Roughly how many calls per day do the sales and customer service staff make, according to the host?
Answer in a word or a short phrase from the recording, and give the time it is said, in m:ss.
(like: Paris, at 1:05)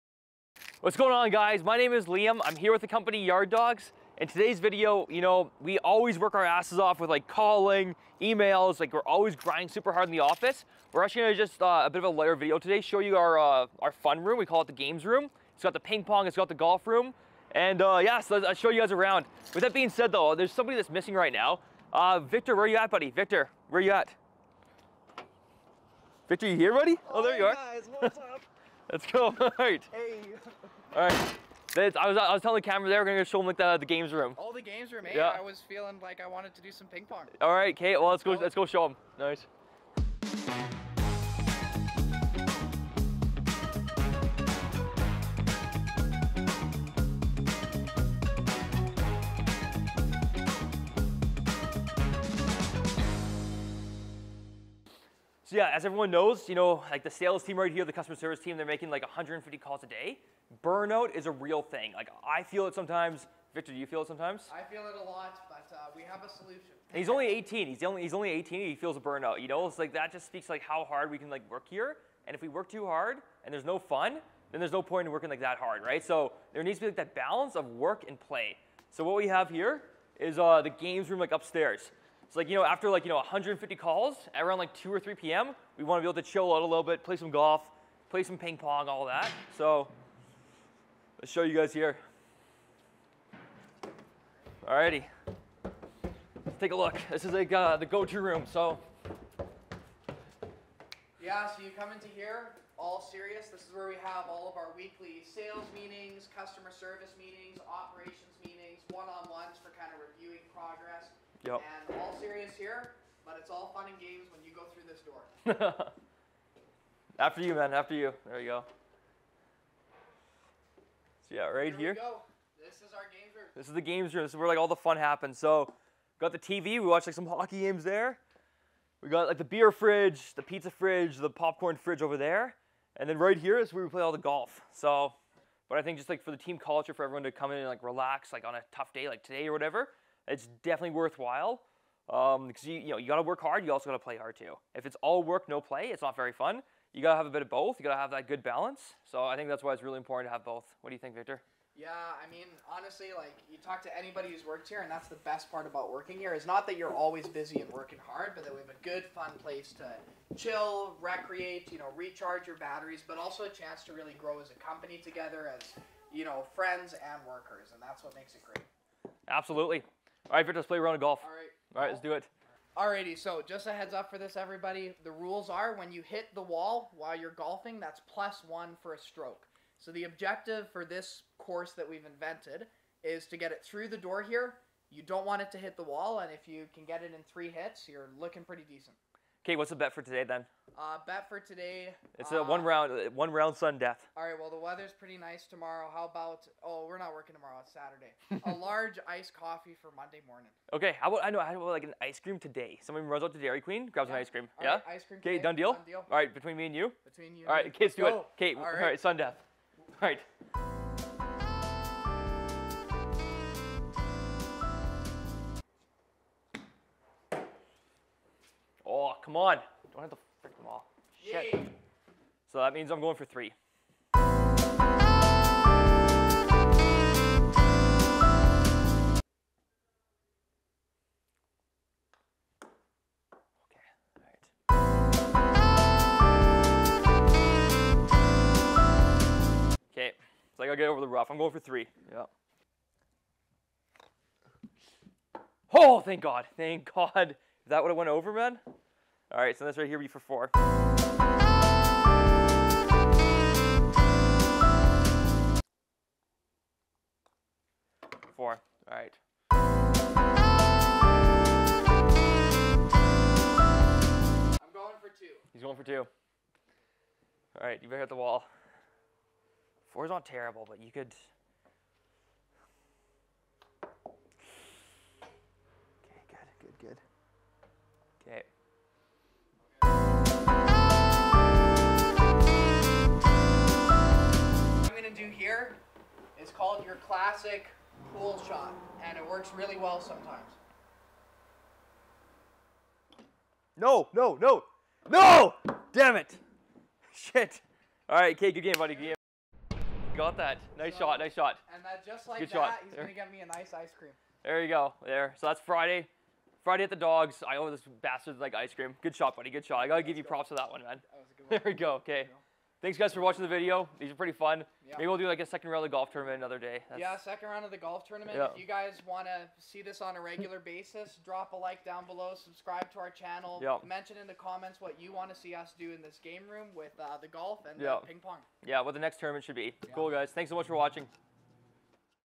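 150, at 0:59.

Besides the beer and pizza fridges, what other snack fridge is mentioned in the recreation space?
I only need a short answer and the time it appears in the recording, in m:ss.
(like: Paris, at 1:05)
popcorn fridge, at 2:11.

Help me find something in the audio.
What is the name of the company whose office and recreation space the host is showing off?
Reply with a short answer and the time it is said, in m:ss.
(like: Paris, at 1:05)
Yard Dawgs, at 0:03.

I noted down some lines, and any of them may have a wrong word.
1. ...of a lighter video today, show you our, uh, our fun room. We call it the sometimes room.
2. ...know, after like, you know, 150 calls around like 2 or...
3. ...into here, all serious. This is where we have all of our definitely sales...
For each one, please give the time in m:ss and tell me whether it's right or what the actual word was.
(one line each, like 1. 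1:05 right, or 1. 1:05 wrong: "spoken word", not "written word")
1. 0:11 wrong: "games", not "sometimes"
2. 1:22 right
3. 1:41 wrong: "weekly", not "definitely".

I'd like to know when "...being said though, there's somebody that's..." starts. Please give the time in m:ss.
0:19.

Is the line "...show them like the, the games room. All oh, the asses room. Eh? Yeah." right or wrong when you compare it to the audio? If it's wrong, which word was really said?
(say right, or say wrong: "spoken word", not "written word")
wrong: "games", not "asses".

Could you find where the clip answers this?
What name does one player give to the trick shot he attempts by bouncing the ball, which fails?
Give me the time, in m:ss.
4:47.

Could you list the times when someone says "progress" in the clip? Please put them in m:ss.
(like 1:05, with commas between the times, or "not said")
1:50.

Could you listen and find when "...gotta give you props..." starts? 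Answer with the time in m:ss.
5:09.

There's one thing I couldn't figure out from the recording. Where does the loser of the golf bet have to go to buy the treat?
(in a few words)
Dairy Queen.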